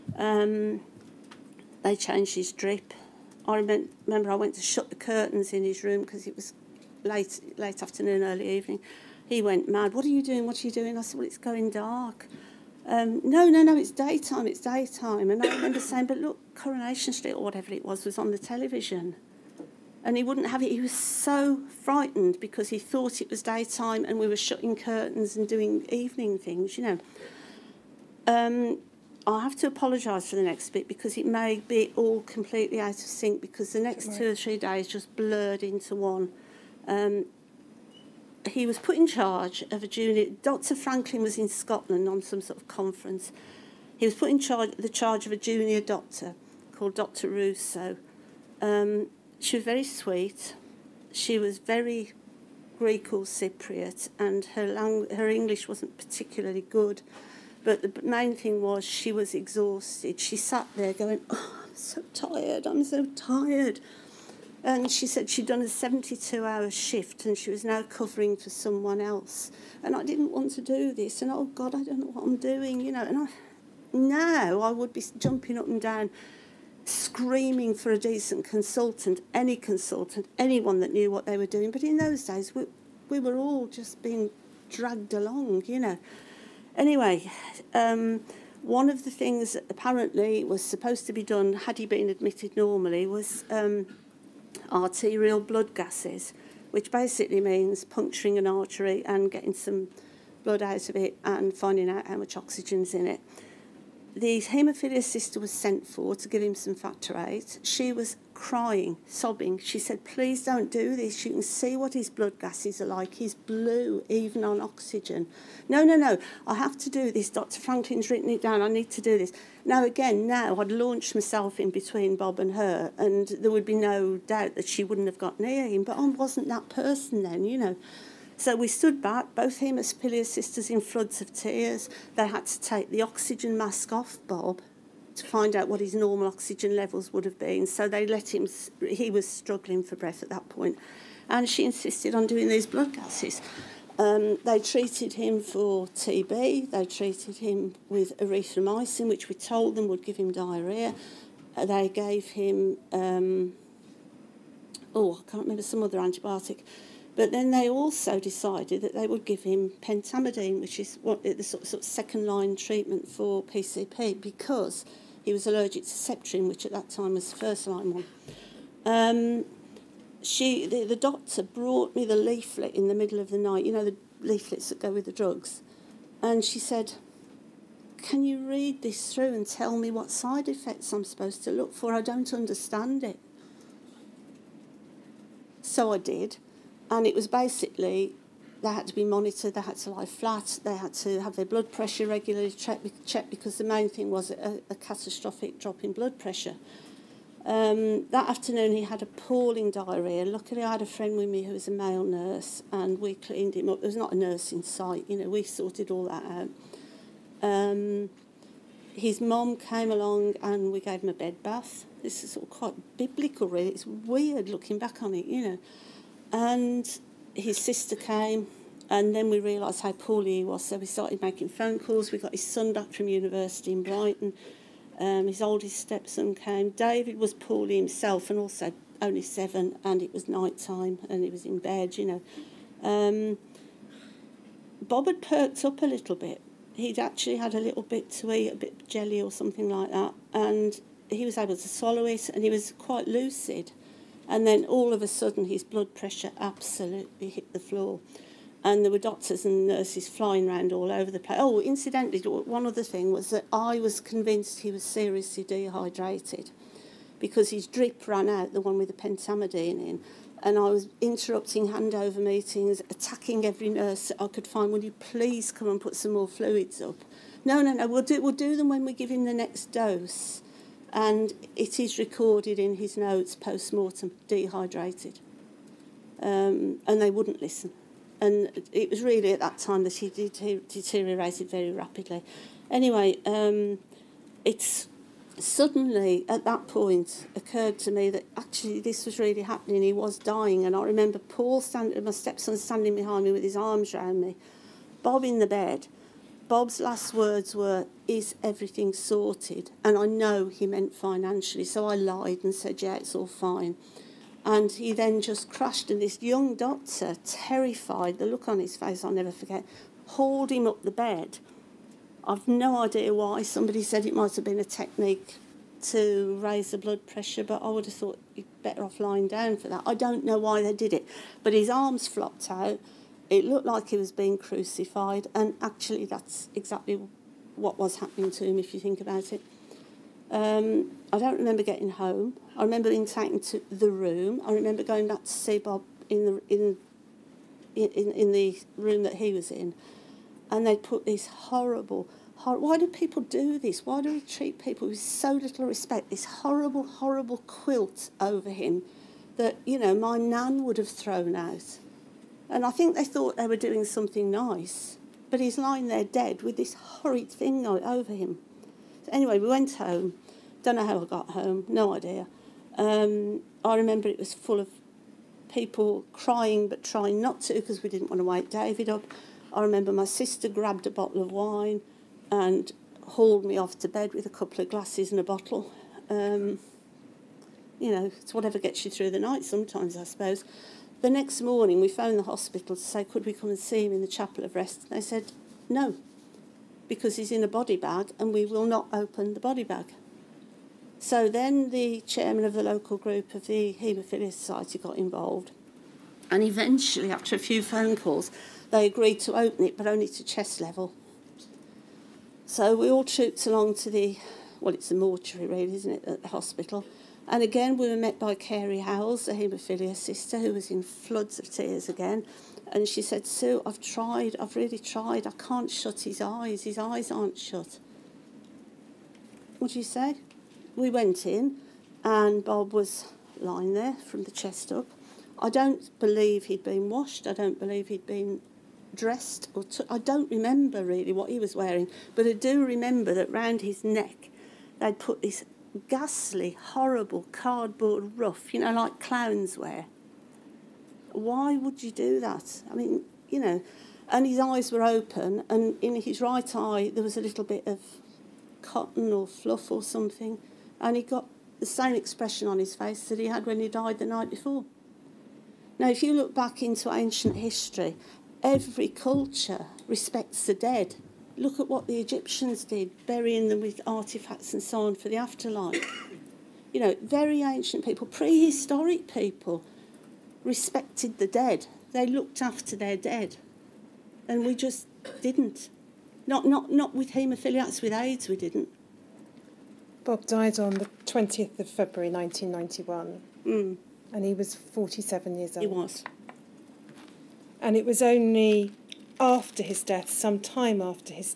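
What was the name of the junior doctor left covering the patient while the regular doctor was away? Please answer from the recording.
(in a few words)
Dr. Russo.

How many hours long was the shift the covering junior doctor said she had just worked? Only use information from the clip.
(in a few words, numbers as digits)
72.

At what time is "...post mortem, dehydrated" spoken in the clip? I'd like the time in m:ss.
4:33.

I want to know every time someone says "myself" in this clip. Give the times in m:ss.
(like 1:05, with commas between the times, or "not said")
2:01.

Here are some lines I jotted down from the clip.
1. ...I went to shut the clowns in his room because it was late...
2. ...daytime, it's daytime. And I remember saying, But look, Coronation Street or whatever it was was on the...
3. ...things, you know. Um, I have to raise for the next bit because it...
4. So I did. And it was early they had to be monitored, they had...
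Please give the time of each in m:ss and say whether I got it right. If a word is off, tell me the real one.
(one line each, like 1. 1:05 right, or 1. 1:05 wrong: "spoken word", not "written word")
1. 0:04 wrong: "curtains", not "clowns"
2. 0:13 right
3. 0:26 wrong: "apologise", not "raise"
4. 3:05 wrong: "basically", not "early".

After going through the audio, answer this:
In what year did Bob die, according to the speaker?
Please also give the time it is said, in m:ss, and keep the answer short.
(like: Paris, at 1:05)
1991, at 8:02.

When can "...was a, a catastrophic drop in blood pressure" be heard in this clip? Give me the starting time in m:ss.
3:14.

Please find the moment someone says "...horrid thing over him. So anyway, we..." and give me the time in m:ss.
5:56.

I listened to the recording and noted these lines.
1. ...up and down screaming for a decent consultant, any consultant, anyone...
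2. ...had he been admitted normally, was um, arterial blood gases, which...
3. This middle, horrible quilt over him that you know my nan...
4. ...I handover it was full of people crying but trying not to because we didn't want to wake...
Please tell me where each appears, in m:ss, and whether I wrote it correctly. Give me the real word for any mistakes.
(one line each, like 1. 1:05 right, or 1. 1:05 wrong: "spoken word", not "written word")
1. 1:15 right
2. 1:31 right
3. 5:46 wrong: "horrible", not "middle"
4. 6:03 wrong: "remember", not "handover".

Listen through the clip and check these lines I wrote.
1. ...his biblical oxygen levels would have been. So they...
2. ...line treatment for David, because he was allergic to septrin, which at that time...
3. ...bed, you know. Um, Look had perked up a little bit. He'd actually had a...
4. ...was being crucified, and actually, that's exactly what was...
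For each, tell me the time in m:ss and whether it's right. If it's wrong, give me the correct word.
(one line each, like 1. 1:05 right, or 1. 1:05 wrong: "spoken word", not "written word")
1. 2:15 wrong: "normal", not "biblical"
2. 2:42 wrong: "PCP", not "David"
3. 3:51 wrong: "Bob", not "Look"
4. 5:23 right.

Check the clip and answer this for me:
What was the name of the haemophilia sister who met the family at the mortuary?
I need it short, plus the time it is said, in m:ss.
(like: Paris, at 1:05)
Carrie Howells, at 6:48.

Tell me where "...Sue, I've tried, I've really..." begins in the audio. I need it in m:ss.
6:53.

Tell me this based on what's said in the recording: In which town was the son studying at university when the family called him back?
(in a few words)
Brighton.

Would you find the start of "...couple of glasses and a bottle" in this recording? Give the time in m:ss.
6:14.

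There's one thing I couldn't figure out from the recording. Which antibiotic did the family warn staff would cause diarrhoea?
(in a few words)
erythromycin.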